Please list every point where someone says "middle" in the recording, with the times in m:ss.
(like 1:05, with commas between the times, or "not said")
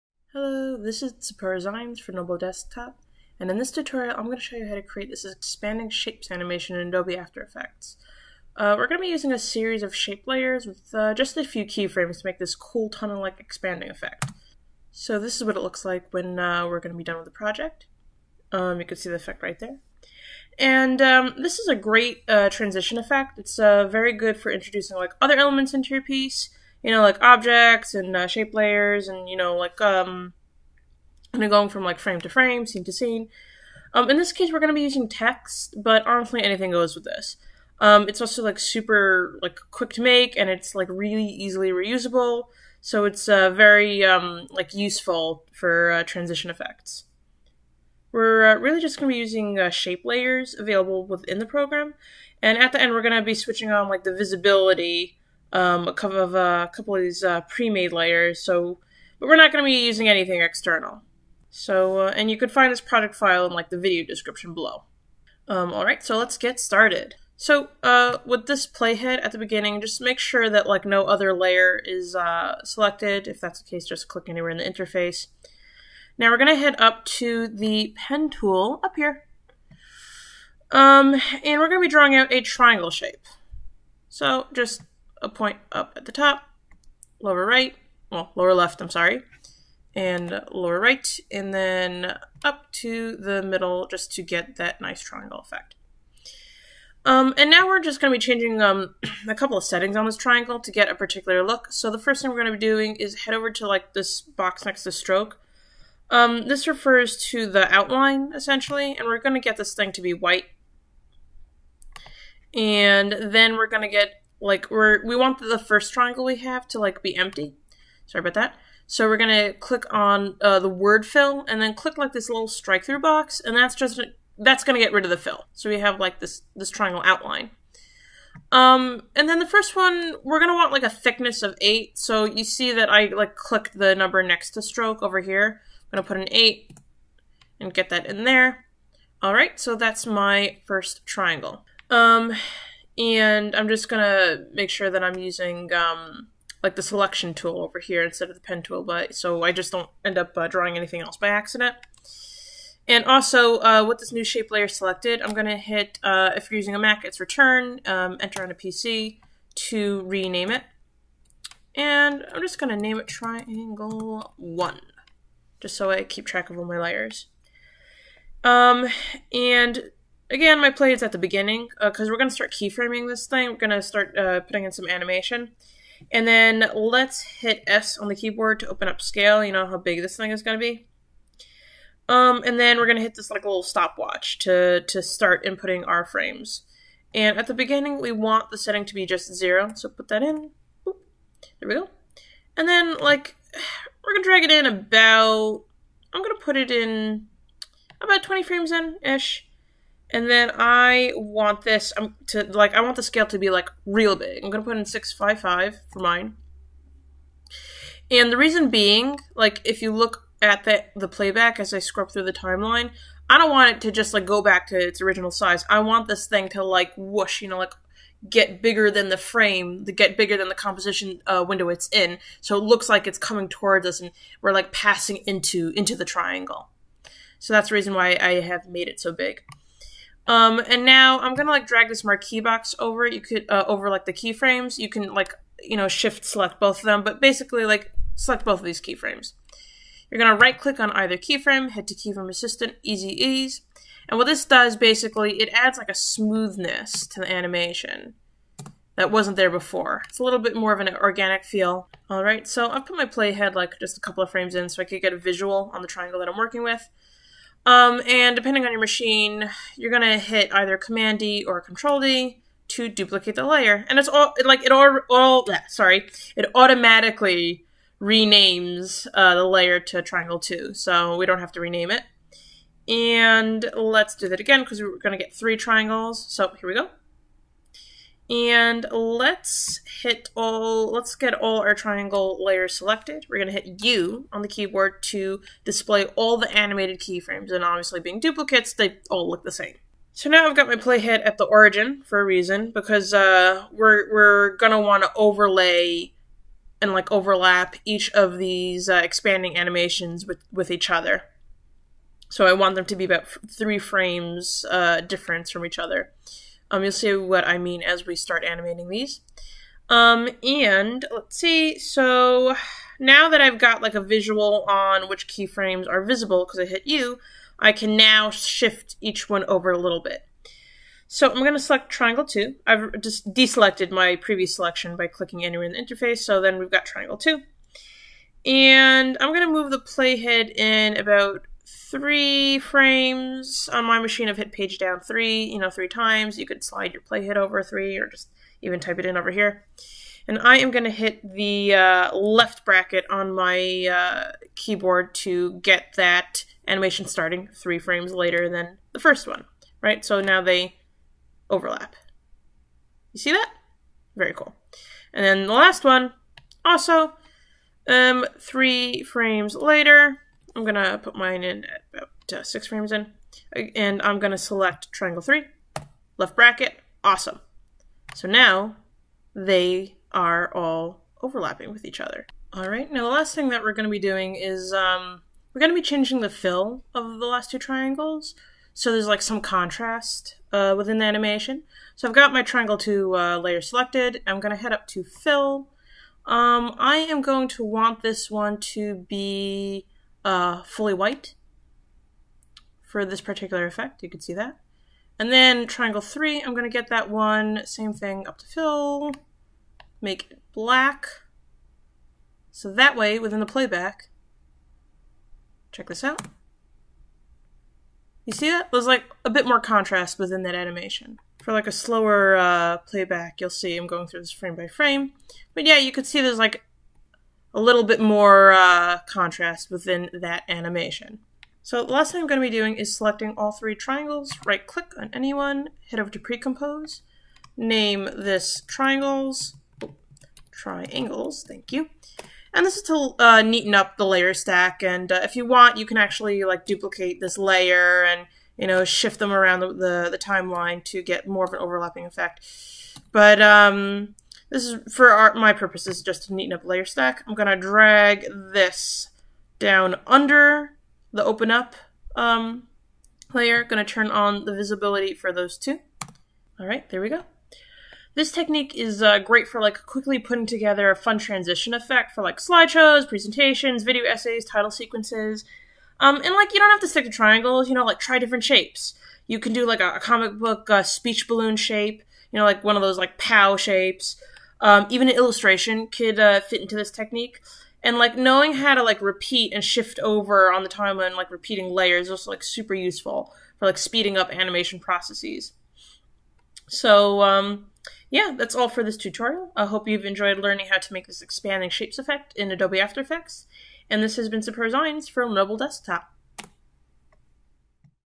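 1:33.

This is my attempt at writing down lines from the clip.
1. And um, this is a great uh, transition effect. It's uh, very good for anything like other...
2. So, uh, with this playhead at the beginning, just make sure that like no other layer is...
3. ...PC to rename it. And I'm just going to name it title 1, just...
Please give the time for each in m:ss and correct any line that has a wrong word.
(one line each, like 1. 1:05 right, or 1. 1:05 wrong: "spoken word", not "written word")
1. 0:20 wrong: "introducing", not "anything"
2. 1:07 right
3. 2:38 wrong: "triangle", not "title".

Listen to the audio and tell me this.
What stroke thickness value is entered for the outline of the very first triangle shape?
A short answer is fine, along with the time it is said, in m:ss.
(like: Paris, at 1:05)
8, at 2:10.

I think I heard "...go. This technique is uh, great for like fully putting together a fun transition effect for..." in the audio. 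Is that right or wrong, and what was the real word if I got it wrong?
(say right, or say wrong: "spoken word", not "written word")
wrong: "quickly", not "fully".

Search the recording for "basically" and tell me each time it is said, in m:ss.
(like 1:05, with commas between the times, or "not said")
3:57, 4:04.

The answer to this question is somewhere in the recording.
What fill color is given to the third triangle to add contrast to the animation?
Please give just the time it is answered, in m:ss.
6:40.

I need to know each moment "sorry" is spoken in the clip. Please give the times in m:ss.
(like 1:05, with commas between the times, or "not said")
1:28, 1:58, 4:25.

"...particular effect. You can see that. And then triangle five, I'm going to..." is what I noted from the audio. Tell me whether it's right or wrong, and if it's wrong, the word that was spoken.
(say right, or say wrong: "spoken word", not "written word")
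wrong: "three", not "five".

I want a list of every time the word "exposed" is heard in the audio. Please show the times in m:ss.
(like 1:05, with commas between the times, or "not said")
not said.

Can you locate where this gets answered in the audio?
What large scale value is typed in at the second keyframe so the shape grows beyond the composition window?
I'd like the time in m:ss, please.
3:24.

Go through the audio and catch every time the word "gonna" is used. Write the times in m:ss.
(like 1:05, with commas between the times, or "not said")
3:24, 3:51, 4:00, 4:19, 4:34, 4:43, 4:54.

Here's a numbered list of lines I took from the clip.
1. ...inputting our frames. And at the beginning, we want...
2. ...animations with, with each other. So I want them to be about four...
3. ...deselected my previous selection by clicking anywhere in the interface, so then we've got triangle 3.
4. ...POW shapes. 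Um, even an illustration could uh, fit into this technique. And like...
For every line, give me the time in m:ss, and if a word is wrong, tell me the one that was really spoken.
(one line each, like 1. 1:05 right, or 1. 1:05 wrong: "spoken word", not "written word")
1. 3:05 right
2. 4:59 wrong: "three", not "four"
3. 5:23 wrong: "2", not "3"
4. 7:53 right.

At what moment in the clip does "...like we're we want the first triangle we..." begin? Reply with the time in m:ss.
1:54.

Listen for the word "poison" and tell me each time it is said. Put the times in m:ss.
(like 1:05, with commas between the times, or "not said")
not said.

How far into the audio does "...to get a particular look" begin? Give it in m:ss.
1:40.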